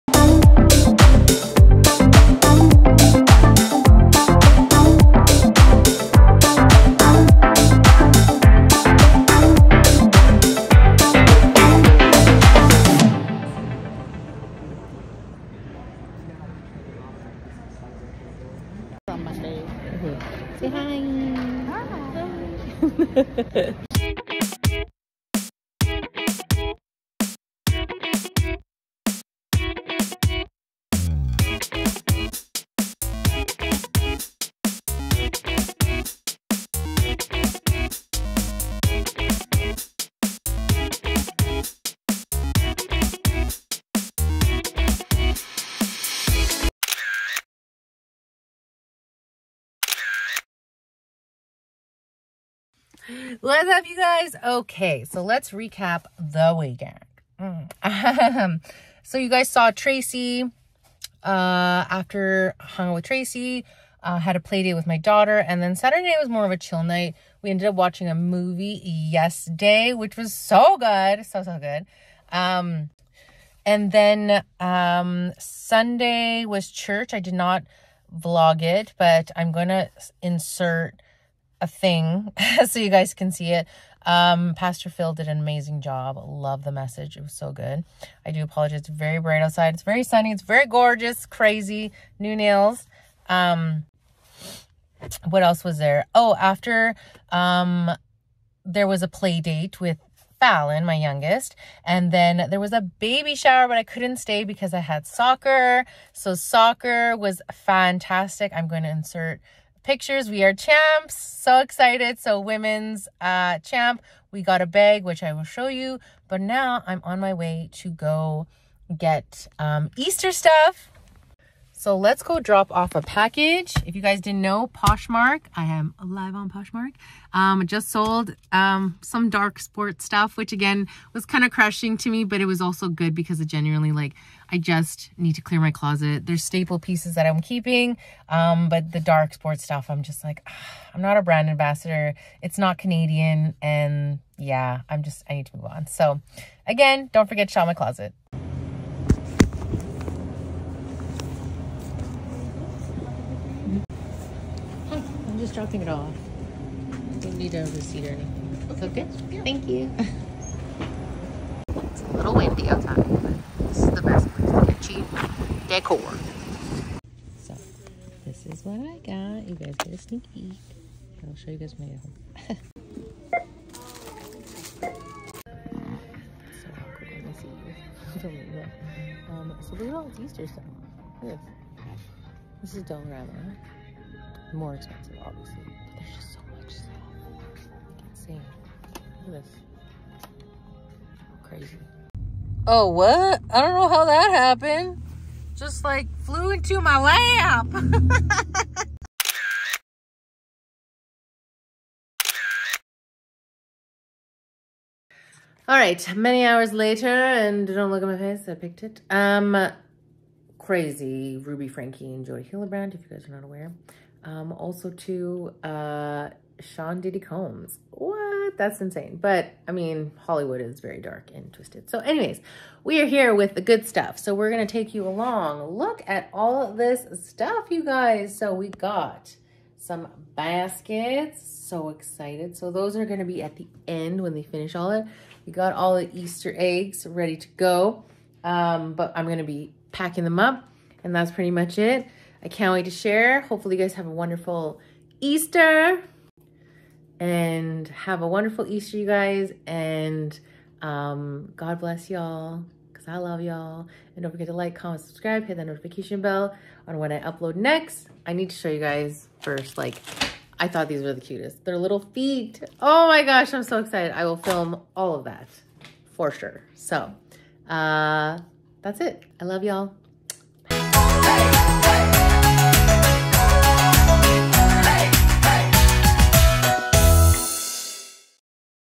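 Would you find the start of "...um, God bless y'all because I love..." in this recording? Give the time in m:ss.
4:10.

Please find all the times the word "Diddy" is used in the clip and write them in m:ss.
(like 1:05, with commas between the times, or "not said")
3:37.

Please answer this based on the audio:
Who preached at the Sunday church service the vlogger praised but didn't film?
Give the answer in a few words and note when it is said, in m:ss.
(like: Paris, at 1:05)
Pastor Phil, at 1:24.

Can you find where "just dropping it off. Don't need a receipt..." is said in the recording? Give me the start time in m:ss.
2:35.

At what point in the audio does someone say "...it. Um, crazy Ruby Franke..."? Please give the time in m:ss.
3:28.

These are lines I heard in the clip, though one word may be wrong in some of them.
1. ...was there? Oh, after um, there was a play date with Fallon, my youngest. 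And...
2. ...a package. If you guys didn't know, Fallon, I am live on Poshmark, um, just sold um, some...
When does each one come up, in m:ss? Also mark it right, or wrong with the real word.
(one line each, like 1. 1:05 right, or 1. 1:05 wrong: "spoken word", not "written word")
1. 1:35 right
2. 2:02 wrong: "Poshmark", not "Fallon".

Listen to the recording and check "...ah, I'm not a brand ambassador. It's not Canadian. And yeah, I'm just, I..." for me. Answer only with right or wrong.
right.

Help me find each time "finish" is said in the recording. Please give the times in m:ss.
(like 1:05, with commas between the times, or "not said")
3:54.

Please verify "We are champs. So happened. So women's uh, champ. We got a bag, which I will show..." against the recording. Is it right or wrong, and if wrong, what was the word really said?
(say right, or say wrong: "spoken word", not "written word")
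wrong: "excited", not "happened".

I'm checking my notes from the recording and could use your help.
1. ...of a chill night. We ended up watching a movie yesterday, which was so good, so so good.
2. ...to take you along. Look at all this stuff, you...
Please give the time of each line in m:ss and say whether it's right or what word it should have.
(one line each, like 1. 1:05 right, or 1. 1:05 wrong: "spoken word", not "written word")
1. 1:06 right
2. 3:44 right.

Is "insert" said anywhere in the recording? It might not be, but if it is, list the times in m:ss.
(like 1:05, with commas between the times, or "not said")
1:20, 1:48.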